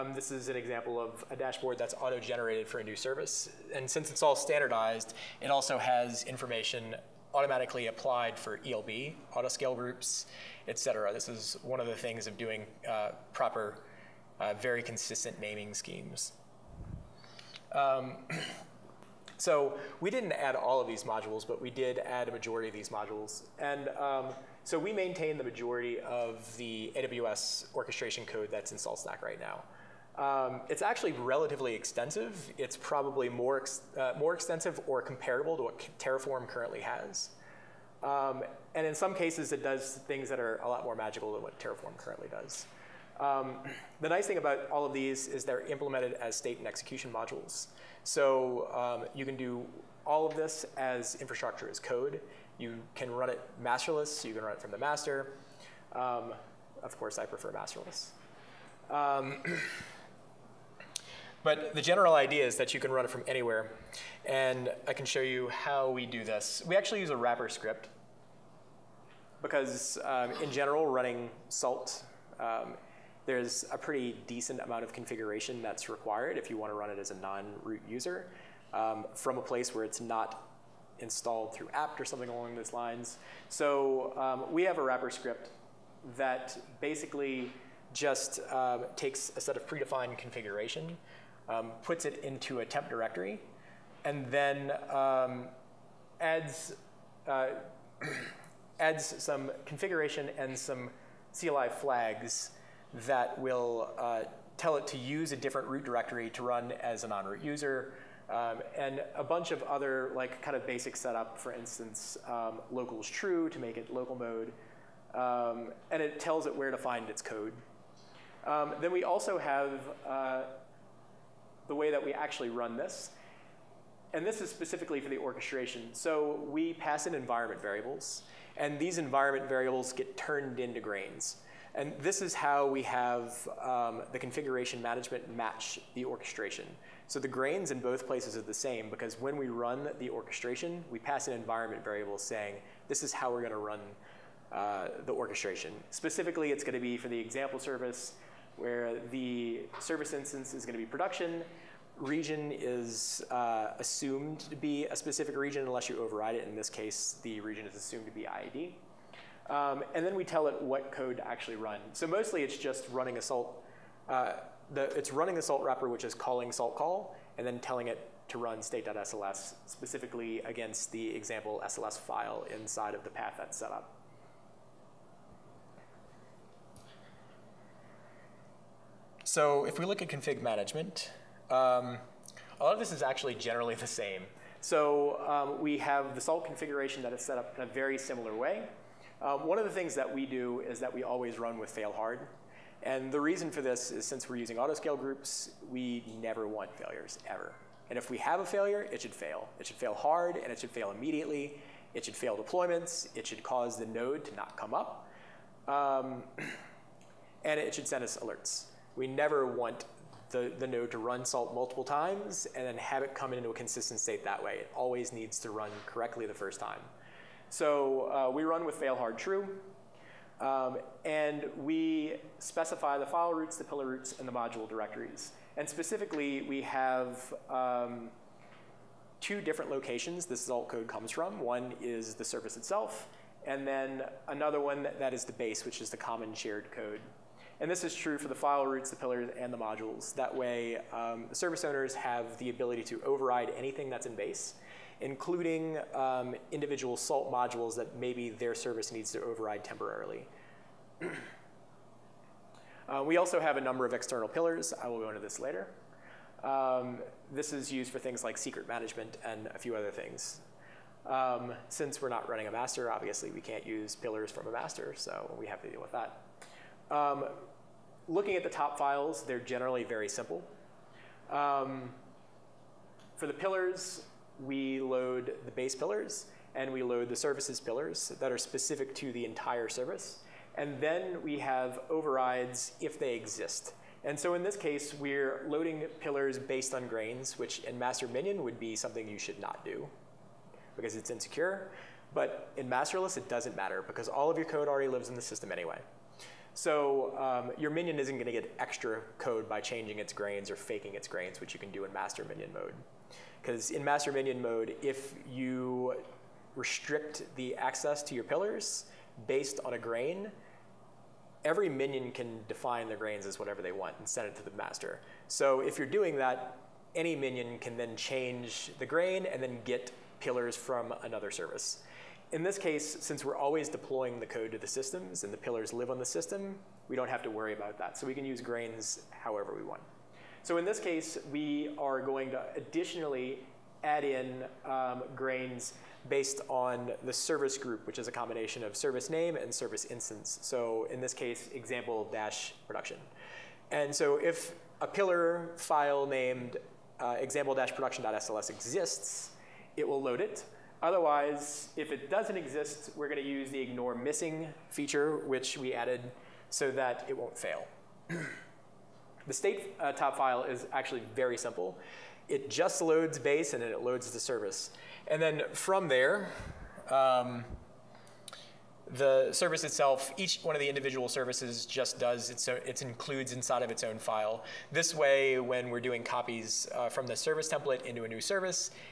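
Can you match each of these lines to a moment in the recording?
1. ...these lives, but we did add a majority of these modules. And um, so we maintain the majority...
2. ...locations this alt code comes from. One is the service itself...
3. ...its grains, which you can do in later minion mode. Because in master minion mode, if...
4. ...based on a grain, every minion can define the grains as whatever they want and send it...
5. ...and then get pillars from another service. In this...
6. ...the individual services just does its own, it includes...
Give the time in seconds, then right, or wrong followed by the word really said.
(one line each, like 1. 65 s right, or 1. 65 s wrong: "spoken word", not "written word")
1. 20 s wrong: "modules", not "lives"
2. 229 s right
3. 300 s wrong: "master", not "later"
4. 309 s right
5. 319 s right
6. 370 s right.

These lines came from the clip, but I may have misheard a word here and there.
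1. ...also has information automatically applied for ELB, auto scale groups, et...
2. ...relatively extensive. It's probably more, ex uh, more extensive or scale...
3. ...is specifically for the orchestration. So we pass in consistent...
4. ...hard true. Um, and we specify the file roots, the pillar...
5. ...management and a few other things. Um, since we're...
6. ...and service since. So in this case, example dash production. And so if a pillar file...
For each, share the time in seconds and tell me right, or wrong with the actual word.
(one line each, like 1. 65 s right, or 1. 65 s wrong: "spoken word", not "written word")
1. 5 s right
2. 31 s wrong: "comparable", not "scale"
3. 124 s wrong: "environment", not "consistent"
4. 218 s right
5. 258 s right
6. 339 s wrong: "instance", not "since".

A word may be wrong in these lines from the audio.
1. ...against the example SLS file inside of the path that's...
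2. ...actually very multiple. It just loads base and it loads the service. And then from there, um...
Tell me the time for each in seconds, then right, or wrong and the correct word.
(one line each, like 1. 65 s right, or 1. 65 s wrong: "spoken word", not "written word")
1. 170 s right
2. 360 s wrong: "simple", not "multiple".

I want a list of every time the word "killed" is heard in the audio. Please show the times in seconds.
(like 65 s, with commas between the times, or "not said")
not said.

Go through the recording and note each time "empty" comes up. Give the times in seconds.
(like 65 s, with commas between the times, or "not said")
not said.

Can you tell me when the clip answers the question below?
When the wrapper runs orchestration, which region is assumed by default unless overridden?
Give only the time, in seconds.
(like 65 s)
158 s.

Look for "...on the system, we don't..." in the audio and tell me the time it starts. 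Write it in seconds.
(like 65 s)
325 s.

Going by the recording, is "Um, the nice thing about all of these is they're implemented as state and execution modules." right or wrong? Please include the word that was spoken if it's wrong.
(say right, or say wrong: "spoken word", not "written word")
right.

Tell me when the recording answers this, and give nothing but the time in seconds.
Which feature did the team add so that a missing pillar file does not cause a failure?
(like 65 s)
353 s.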